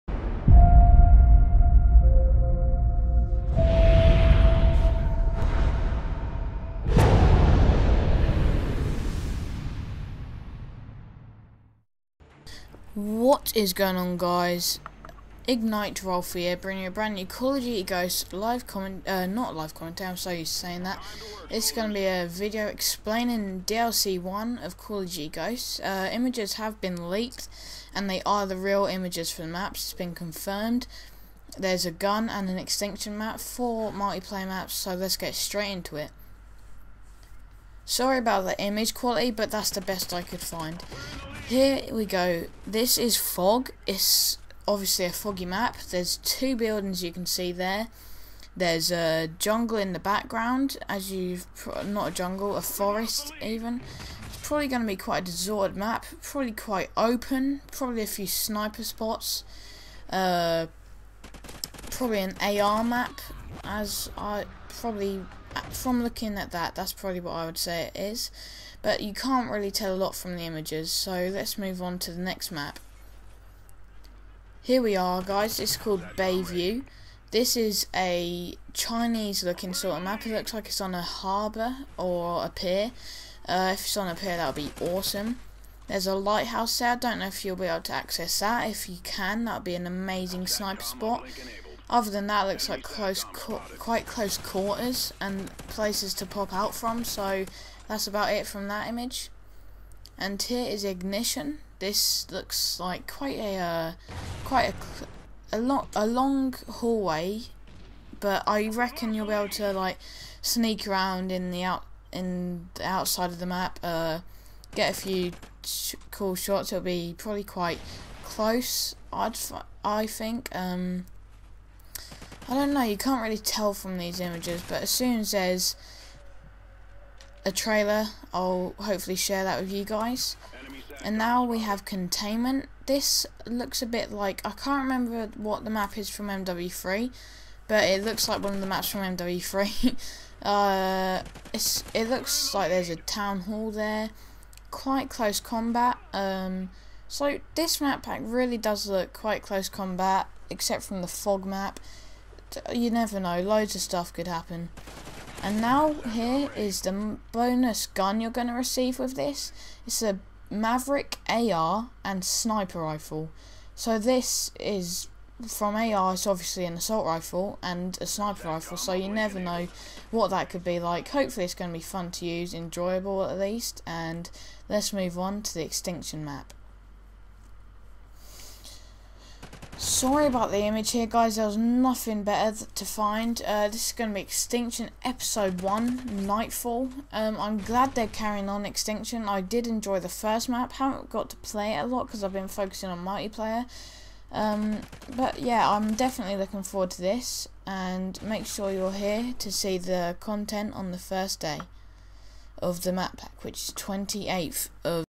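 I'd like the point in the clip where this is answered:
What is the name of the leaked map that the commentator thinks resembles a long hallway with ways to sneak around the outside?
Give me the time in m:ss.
1:40.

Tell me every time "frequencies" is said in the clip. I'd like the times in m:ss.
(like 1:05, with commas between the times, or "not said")
not said.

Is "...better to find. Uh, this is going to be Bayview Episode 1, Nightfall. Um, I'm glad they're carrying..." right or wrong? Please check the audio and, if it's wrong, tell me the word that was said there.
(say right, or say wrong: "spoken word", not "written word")
wrong: "Extinction", not "Bayview".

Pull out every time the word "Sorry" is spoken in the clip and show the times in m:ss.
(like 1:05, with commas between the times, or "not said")
0:37, 2:59.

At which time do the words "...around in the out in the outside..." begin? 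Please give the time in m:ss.
1:50.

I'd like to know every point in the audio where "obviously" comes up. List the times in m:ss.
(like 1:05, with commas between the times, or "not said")
0:44, 2:46.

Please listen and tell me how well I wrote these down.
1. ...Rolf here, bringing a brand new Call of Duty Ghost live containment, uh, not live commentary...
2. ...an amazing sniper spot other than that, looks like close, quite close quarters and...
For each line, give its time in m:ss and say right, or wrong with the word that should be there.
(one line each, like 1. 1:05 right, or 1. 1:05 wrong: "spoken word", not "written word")
1. 0:16 wrong: "comment", not "containment"
2. 1:29 right.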